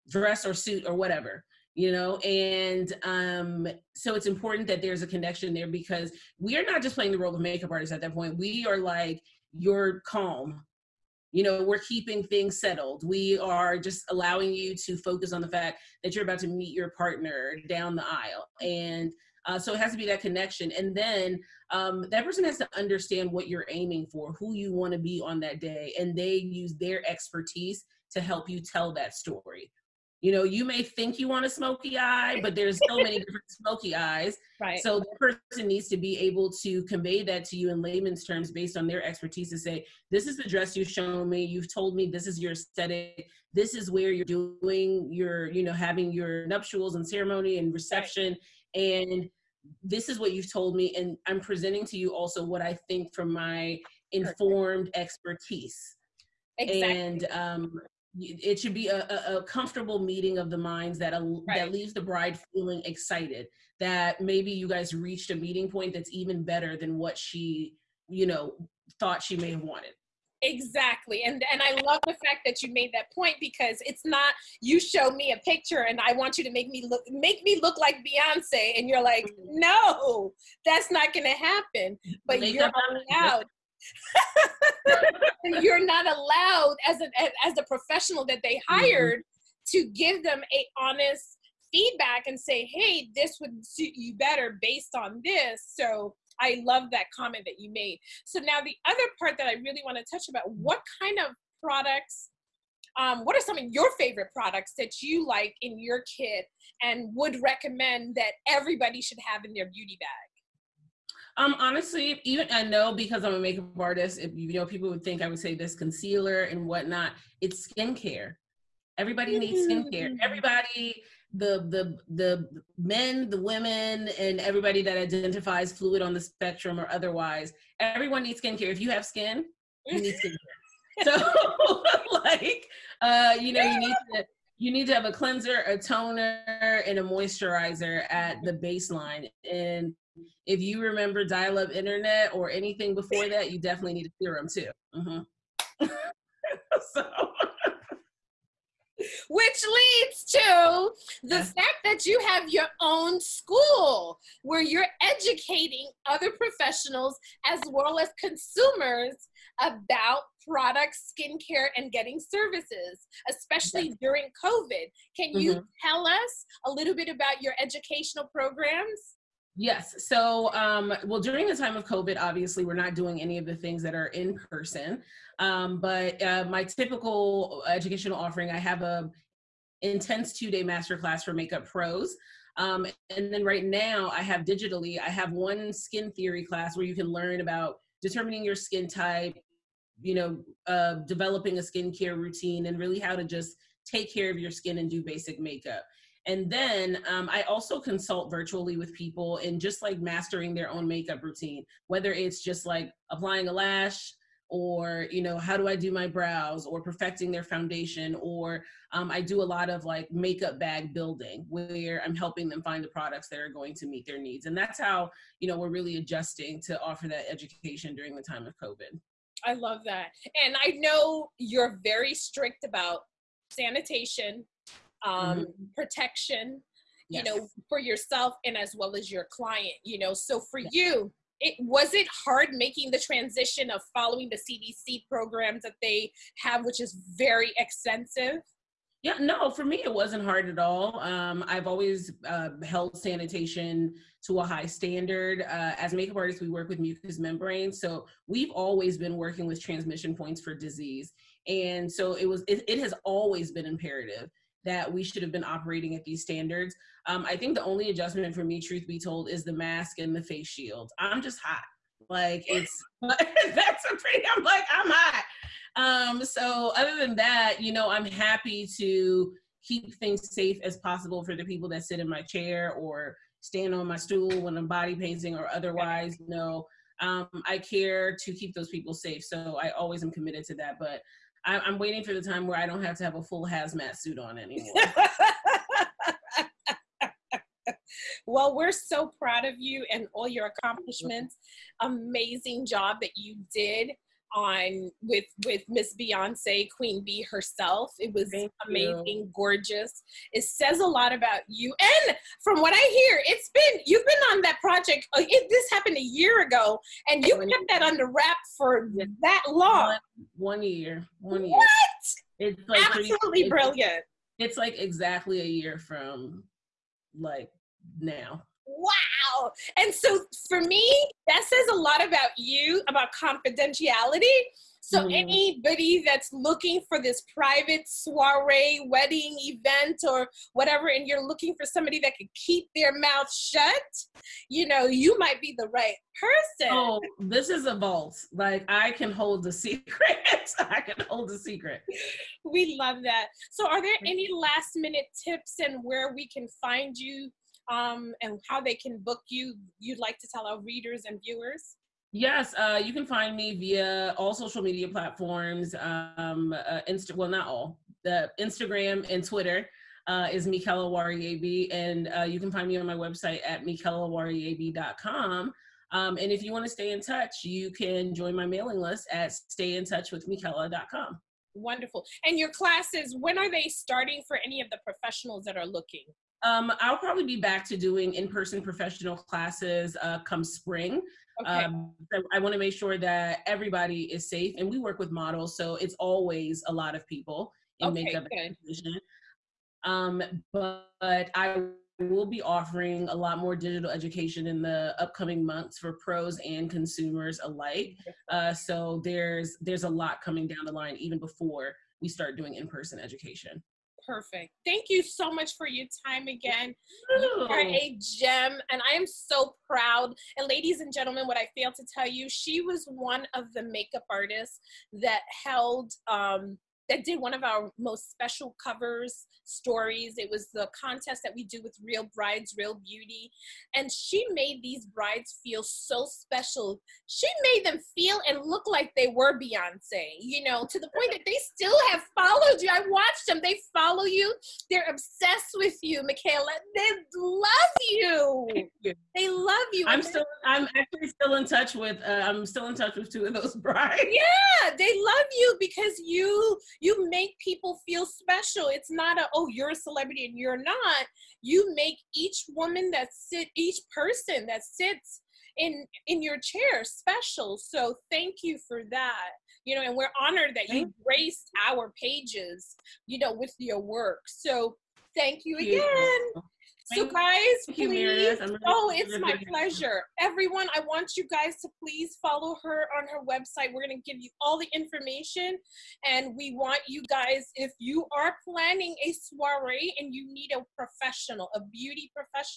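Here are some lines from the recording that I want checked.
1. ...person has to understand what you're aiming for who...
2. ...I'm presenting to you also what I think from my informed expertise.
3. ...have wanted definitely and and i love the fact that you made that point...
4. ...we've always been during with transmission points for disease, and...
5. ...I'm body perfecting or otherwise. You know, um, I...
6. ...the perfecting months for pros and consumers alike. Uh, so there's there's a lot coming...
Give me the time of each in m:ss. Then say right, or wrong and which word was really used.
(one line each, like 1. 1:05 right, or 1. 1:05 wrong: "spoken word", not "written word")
1. 0:22 right
2. 0:51 right
3. 1:09 wrong: "exactly", not "definitely"
4. 4:08 wrong: "working", not "during"
5. 4:34 wrong: "painting", not "perfecting"
6. 6:34 wrong: "upcoming", not "perfecting".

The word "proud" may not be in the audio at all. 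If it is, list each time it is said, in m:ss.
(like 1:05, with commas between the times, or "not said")
4:49, 6:49.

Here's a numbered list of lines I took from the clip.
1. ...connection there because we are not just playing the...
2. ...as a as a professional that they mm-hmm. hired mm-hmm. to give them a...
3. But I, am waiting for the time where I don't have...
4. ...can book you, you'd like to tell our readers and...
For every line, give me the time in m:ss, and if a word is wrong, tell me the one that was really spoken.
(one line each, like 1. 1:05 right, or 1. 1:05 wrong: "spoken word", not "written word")
1. 0:05 right
2. 1:26 right
3. 4:40 right
4. 5:48 right.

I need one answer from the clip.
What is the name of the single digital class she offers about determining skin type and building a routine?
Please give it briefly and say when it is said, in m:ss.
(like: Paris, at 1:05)
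skin theory, at 3:05.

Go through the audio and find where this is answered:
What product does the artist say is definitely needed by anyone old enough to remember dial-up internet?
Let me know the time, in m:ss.
2:24.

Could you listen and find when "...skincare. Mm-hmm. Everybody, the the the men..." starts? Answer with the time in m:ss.
1:59.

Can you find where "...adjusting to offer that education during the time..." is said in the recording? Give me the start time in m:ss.
3:35.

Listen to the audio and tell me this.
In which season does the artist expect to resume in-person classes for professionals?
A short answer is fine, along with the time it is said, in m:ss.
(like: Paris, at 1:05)
spring, at 6:20.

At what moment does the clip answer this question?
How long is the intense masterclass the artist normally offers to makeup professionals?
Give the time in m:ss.
3:00.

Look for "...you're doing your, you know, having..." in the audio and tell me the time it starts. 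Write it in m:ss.
0:44.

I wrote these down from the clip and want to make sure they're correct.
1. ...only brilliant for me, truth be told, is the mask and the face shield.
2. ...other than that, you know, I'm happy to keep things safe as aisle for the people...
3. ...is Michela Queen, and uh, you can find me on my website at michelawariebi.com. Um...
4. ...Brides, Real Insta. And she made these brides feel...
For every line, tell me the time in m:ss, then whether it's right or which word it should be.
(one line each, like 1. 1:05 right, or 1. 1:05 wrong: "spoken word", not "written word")
1. 4:17 wrong: "adjustment", not "brilliant"
2. 4:26 wrong: "possible", not "aisle"
3. 6:00 wrong: "Wariebi", not "Queen"
4. 7:02 wrong: "Beauty", not "Insta".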